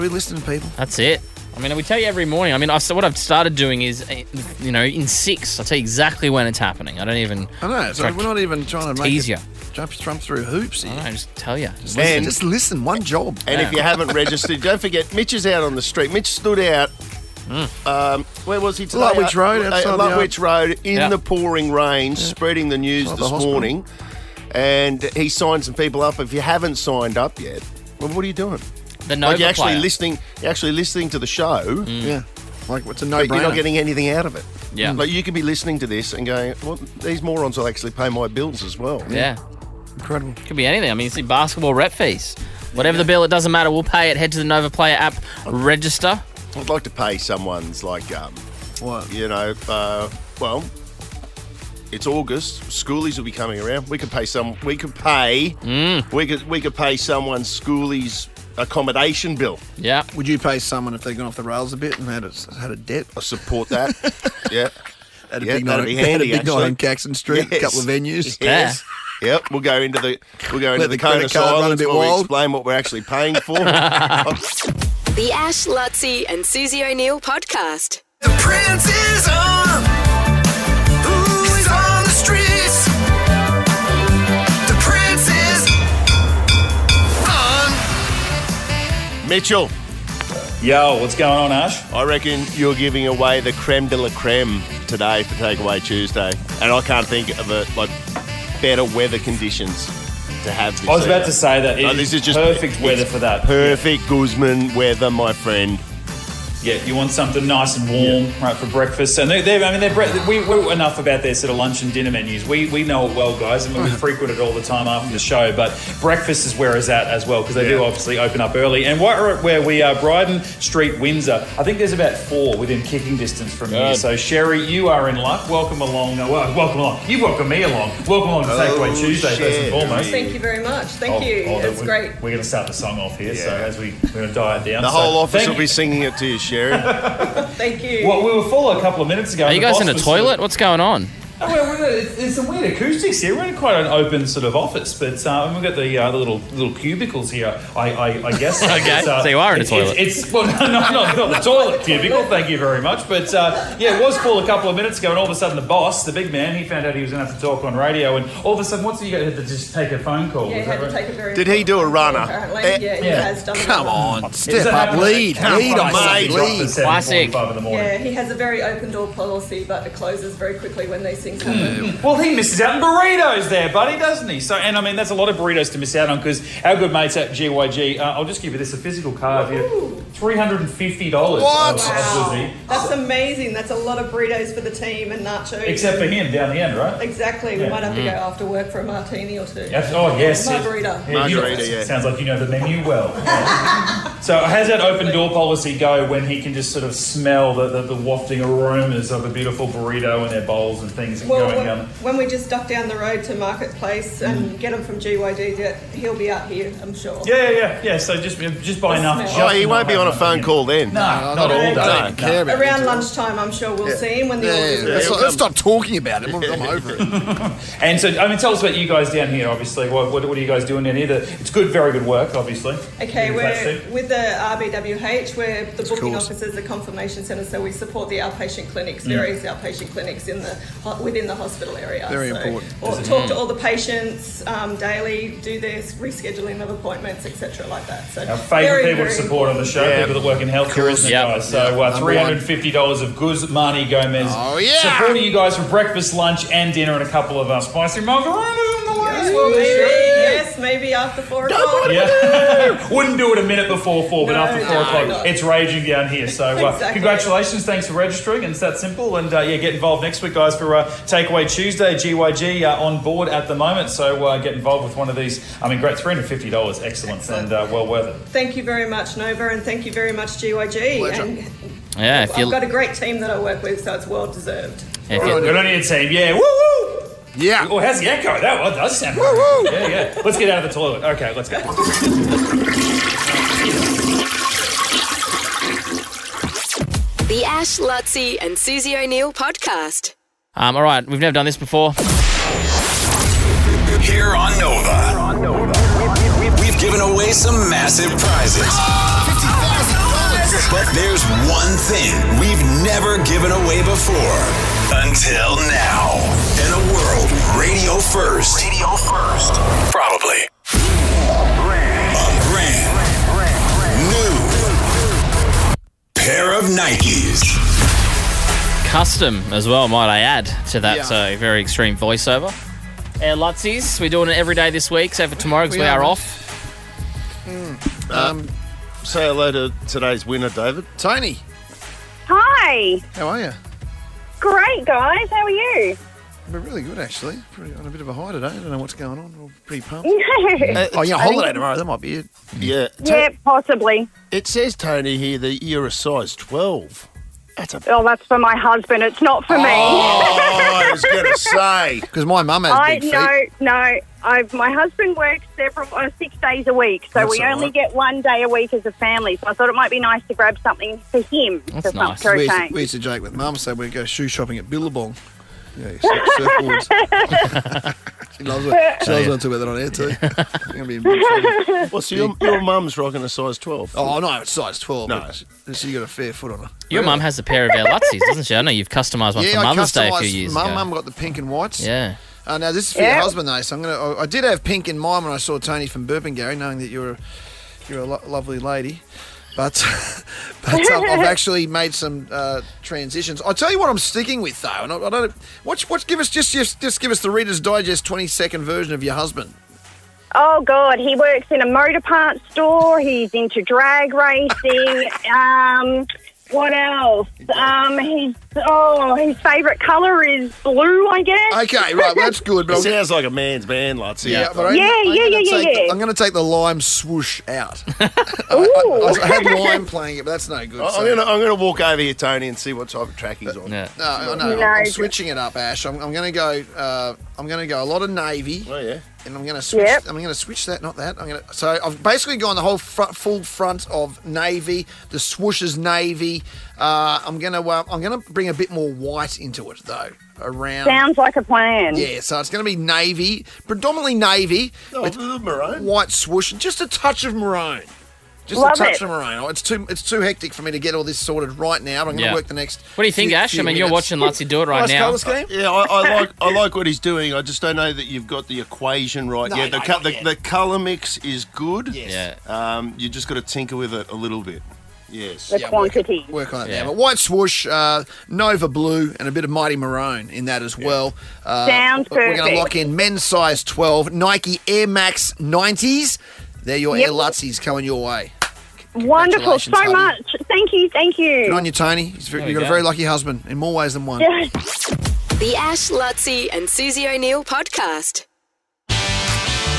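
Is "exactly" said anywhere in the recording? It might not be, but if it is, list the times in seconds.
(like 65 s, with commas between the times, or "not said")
5 s, 186 s, 256 s.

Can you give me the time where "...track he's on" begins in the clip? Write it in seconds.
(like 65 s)
423 s.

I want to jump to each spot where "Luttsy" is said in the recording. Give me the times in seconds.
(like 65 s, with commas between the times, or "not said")
75 s, 287 s, 323 s, 377 s, 454 s, 485 s.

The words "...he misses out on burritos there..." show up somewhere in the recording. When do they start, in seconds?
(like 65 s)
172 s.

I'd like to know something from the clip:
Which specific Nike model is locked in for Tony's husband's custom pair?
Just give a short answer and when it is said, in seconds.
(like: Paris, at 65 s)
Air Max 90s, at 474 s.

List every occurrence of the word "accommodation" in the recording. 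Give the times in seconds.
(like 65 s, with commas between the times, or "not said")
58 s.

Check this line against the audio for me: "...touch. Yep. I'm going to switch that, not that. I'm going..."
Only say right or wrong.
wrong.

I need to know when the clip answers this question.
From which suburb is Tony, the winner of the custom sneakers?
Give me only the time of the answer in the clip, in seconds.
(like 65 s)
386 s.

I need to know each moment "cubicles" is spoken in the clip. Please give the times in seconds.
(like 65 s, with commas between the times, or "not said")
146 s, 151 s.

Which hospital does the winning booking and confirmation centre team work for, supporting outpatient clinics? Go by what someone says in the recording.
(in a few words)
RBWH.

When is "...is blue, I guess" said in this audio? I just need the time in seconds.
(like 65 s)
410 s.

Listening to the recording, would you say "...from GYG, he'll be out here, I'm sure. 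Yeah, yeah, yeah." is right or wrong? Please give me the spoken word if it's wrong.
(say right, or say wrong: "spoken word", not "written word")
right.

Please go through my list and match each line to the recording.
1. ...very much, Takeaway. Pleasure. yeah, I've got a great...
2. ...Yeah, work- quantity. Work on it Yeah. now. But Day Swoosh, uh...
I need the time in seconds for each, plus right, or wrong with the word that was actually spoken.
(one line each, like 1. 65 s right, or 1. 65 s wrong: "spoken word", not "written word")
1. 269 s wrong: "GYG", not "Takeaway"
2. 465 s wrong: "White", not "Day".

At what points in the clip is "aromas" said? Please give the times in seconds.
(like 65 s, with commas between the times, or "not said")
198 s.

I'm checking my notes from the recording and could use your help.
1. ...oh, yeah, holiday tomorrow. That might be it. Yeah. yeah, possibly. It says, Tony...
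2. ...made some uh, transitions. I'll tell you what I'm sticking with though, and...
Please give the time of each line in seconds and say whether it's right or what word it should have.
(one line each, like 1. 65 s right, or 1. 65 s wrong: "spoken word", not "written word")
1. 340 s right
2. 391 s right.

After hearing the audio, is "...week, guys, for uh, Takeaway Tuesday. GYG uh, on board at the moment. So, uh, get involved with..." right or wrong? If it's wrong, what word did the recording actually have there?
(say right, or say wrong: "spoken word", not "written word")
right.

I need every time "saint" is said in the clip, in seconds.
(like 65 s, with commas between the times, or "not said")
not said.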